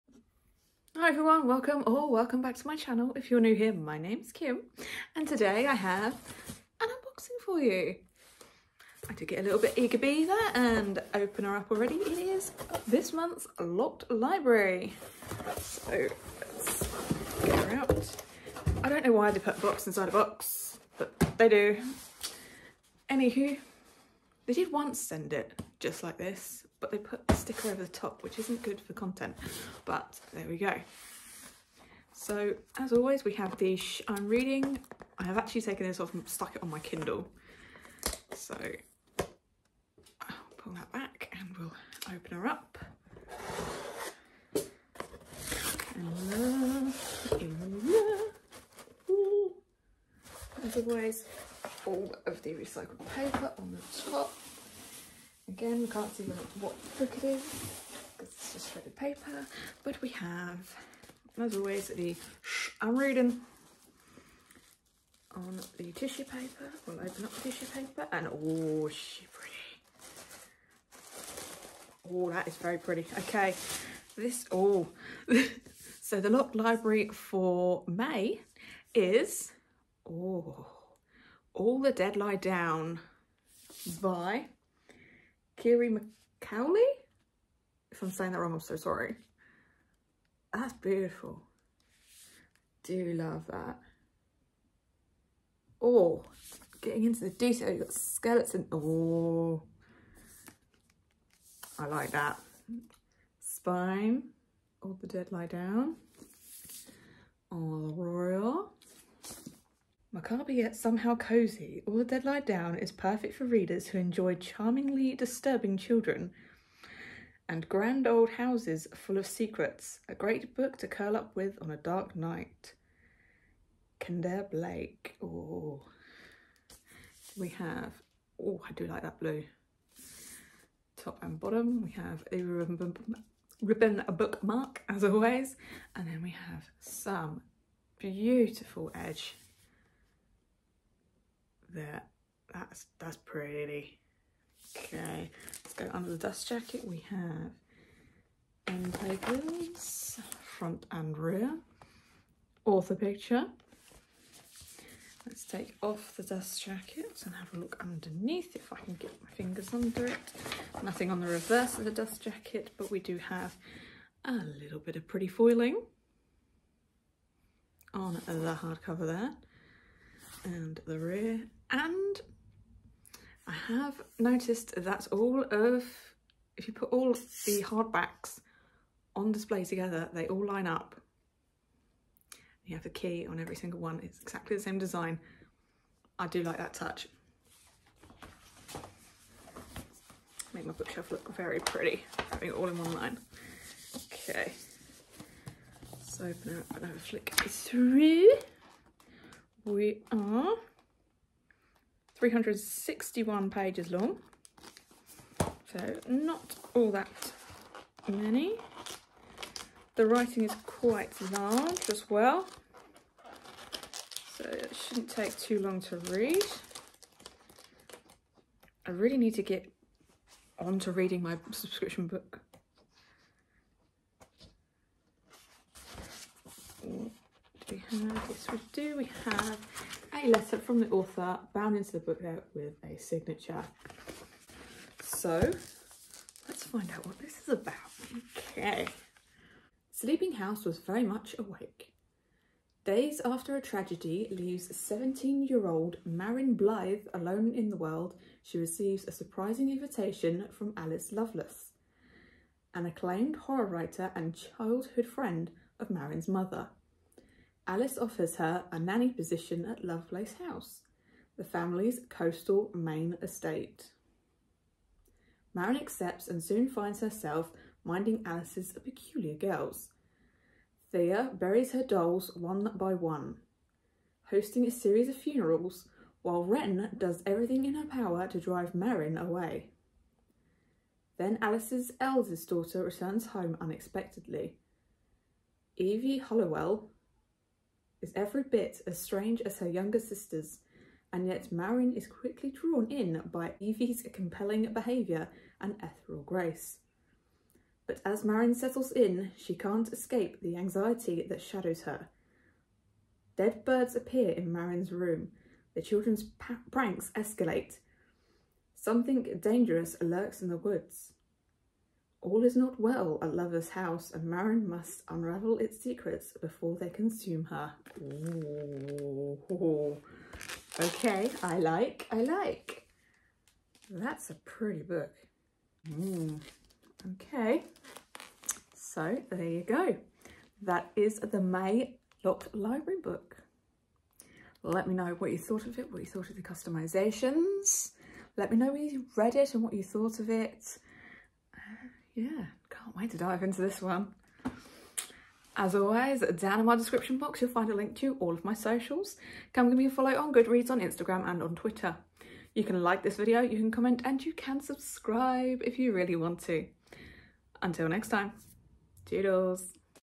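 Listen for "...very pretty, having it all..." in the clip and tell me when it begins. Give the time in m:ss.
3:11.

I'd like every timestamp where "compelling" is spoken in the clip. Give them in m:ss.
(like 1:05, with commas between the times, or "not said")
4:54.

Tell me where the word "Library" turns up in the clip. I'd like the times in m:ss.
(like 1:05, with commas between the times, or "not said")
0:14, 1:16, 5:32.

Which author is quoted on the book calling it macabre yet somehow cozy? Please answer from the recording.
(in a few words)
Kendare Blake.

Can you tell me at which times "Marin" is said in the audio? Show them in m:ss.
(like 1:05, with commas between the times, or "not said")
4:06, 4:15, 4:25, 4:38, 4:51, 4:58, 5:04, 5:14.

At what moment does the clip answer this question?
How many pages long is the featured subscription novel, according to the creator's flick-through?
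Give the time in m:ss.
3:22.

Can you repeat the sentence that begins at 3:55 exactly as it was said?
So let's find out what this is about.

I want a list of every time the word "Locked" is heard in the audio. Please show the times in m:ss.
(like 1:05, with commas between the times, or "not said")
0:13, 1:16, 5:32.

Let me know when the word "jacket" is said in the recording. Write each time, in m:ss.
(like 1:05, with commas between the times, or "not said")
2:26, 2:36, 2:42.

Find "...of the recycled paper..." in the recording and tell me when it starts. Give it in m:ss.
0:52.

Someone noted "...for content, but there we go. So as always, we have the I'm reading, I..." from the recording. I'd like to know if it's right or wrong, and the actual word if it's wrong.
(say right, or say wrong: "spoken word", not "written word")
right.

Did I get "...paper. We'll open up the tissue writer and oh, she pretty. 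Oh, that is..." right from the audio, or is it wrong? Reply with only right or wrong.
wrong.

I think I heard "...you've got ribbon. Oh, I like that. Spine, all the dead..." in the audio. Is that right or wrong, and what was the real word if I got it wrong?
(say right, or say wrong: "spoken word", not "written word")
wrong: "skeleton", not "ribbon".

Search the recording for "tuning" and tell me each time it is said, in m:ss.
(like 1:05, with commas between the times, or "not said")
not said.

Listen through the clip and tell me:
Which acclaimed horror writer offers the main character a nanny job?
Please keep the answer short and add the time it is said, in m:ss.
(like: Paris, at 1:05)
Alice Lovelace, at 4:10.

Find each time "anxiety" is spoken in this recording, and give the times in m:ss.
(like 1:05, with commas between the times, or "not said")
5:00.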